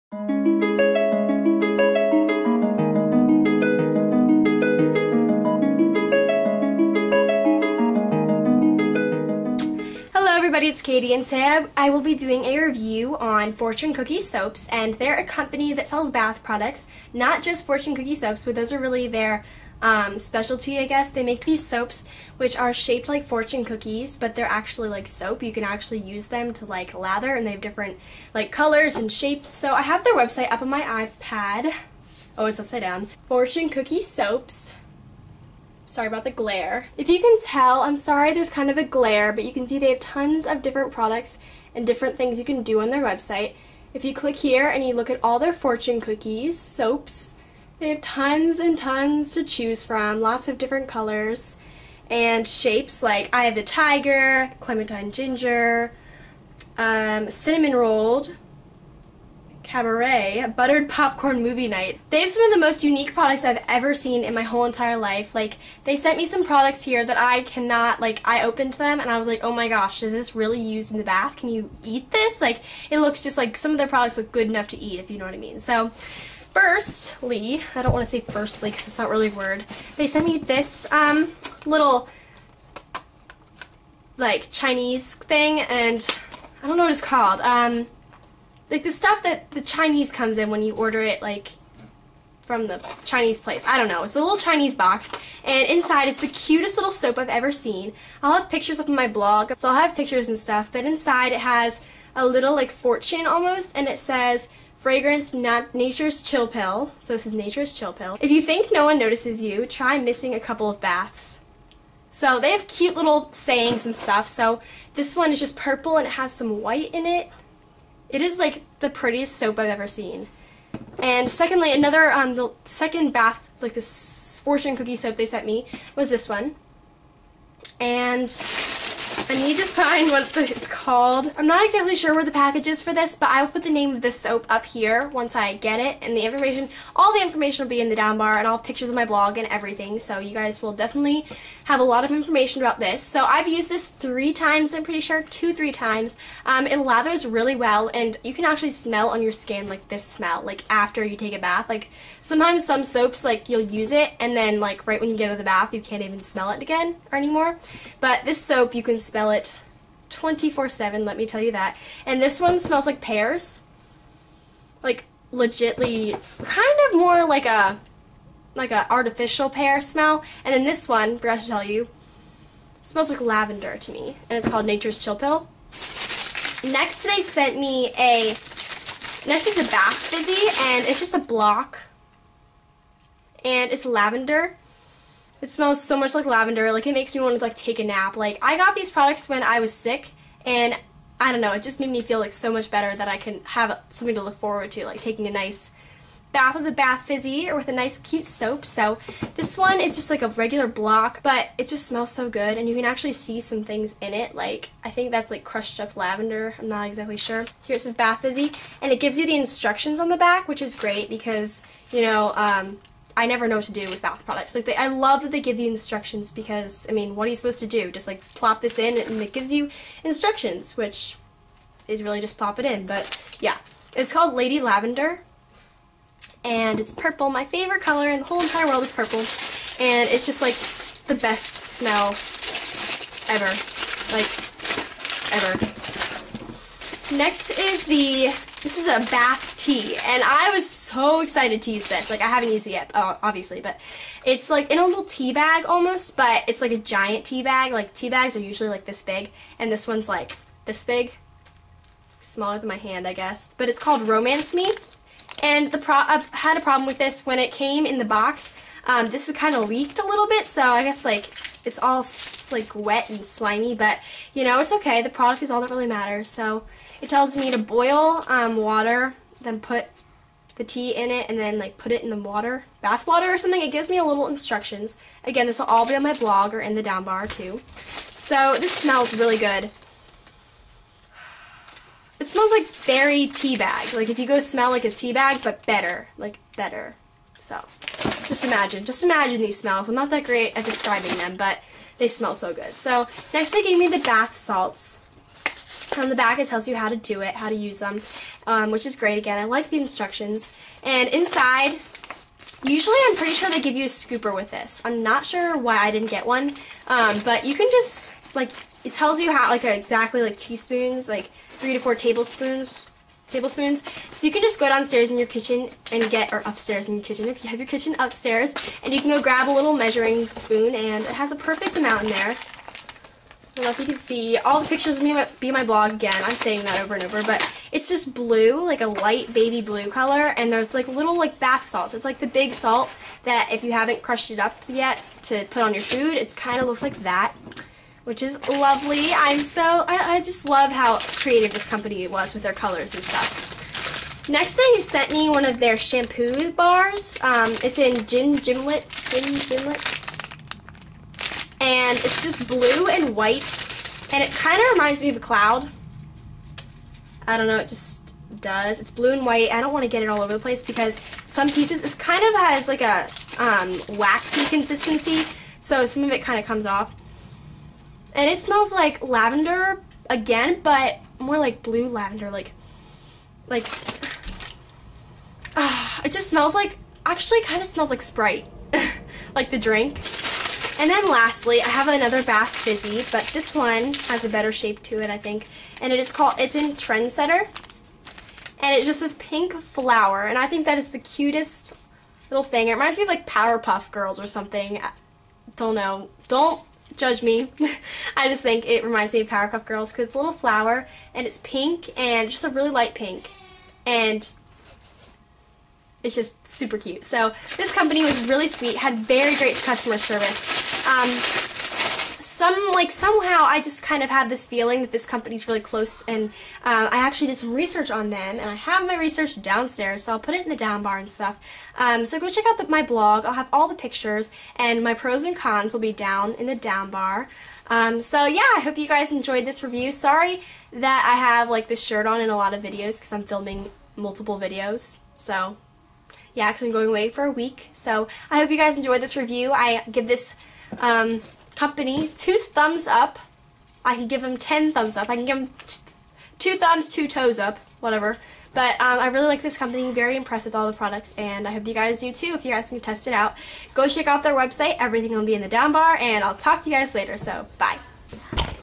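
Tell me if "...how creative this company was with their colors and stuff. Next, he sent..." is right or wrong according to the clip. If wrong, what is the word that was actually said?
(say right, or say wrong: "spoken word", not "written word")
right.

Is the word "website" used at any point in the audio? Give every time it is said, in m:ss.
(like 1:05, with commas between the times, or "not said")
0:30, 0:43, 7:34.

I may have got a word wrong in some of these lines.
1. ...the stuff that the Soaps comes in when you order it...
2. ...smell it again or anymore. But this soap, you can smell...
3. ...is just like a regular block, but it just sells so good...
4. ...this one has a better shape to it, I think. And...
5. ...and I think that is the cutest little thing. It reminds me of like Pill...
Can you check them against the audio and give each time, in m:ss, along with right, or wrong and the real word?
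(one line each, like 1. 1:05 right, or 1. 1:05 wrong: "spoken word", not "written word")
1. 1:28 wrong: "Chinese", not "Soaps"
2. 2:36 right
3. 3:19 wrong: "smells", not "sells"
4. 6:23 right
5. 6:30 wrong: "Powerpuff", not "Pill".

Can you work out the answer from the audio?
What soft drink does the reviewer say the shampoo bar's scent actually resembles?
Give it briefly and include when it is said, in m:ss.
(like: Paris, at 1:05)
Sprite, at 6:18.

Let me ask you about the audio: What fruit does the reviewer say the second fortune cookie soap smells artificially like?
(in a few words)
Pears.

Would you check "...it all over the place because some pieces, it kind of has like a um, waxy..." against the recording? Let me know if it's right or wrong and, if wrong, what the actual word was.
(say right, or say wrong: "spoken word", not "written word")
right.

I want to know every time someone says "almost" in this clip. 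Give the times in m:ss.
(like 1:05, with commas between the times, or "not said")
1:43, 4:05.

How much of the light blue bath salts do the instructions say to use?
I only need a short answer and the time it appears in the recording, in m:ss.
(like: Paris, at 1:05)
3 to 4 tablespoons, at 5:11.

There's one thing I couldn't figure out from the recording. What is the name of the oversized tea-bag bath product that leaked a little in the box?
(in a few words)
Romance Me.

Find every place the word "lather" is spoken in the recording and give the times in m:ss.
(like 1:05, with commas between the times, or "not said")
0:26, 2:26.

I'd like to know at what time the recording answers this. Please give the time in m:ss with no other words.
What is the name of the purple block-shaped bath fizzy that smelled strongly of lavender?
3:44.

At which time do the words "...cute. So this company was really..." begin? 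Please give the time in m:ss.
6:46.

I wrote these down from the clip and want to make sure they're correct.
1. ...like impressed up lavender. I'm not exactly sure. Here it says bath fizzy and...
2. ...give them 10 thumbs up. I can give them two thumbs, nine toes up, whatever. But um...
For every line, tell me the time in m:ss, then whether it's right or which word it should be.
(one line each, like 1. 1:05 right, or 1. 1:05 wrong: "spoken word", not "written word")
1. 3:25 wrong: "crushed", not "impressed"
2. 7:24 wrong: "two", not "nine".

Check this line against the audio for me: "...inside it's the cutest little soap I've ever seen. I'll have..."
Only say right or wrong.
right.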